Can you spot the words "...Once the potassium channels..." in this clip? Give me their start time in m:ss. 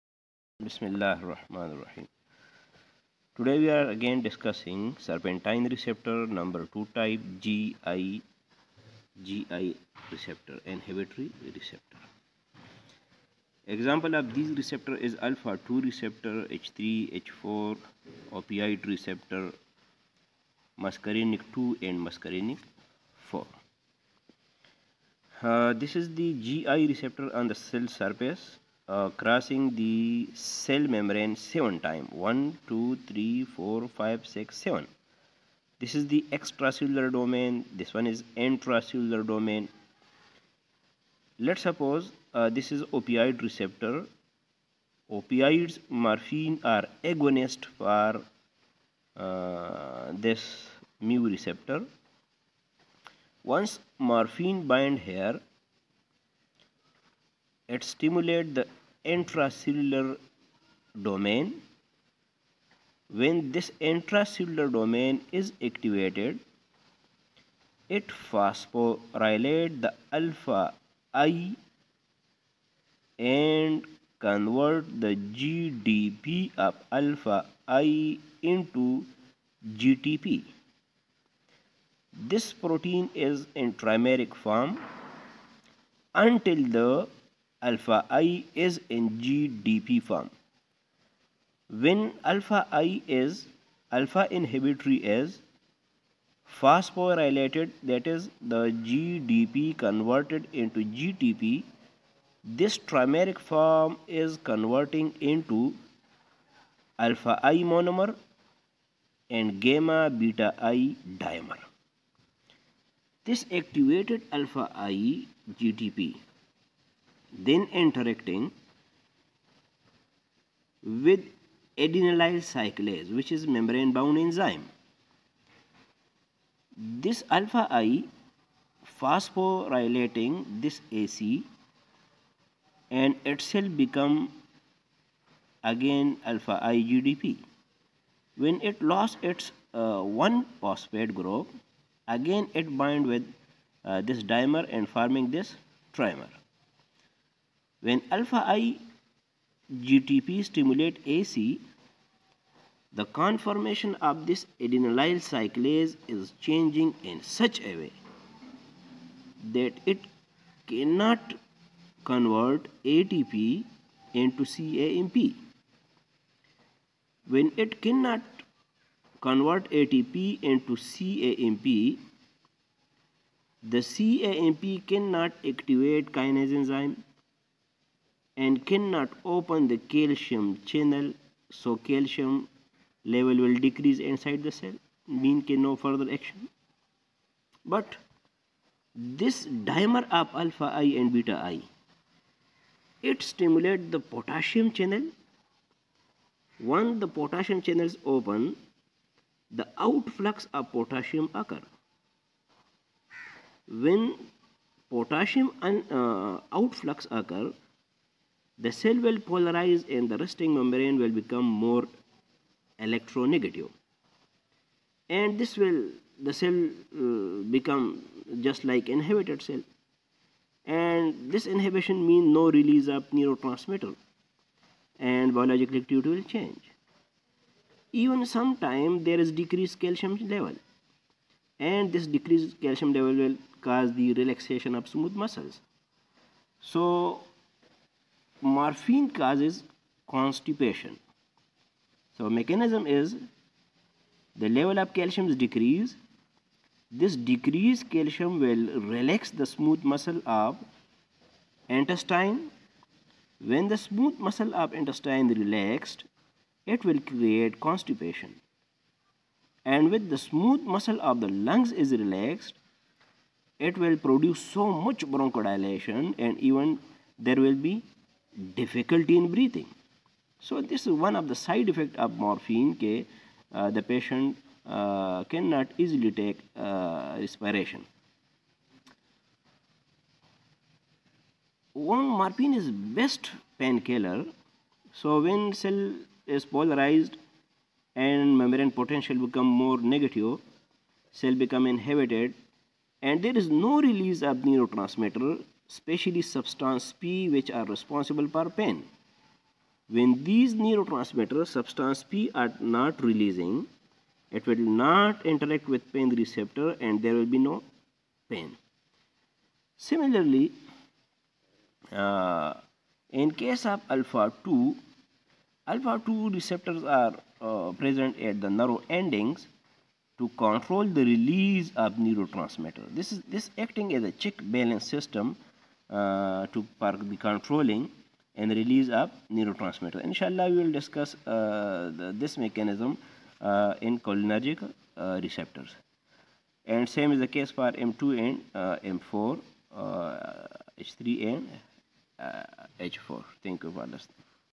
3:16.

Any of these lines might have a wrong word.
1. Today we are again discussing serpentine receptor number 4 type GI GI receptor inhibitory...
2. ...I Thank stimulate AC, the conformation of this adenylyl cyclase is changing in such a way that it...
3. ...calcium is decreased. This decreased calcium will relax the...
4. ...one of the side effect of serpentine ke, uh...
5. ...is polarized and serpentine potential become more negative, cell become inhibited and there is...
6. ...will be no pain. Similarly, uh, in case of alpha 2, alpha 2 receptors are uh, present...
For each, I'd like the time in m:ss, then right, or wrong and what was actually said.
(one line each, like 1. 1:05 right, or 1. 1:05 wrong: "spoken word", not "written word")
1. 0:03 wrong: "2", not "4"
2. 2:28 wrong: "GTP", not "Thank"
3. 4:04 right
4. 4:30 wrong: "morphine", not "serpentine"
5. 4:46 wrong: "membrane", not "serpentine"
6. 5:07 right.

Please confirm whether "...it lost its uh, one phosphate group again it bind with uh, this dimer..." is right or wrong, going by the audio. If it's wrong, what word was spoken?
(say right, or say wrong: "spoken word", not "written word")
right.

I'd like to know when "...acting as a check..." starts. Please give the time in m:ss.
5:23.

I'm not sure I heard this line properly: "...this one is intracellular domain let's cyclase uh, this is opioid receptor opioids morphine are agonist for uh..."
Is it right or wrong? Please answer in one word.
wrong.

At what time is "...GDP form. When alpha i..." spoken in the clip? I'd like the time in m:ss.
1:29.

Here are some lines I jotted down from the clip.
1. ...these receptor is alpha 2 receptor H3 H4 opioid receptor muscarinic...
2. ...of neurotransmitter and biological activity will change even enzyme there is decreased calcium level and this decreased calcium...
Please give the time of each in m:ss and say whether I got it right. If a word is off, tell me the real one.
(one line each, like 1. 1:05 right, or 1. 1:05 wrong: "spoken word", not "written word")
1. 0:14 right
2. 3:42 wrong: "sometime", not "enzyme".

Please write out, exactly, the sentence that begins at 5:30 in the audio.
Inshallah, we will discuss uh, the, this mechanism uh, in cholinergic uh, receptors.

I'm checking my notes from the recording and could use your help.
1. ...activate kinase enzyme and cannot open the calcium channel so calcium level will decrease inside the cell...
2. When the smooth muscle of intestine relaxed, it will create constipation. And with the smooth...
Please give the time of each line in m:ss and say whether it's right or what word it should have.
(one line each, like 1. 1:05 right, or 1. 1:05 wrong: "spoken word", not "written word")
1. 2:55 right
2. 4:13 right.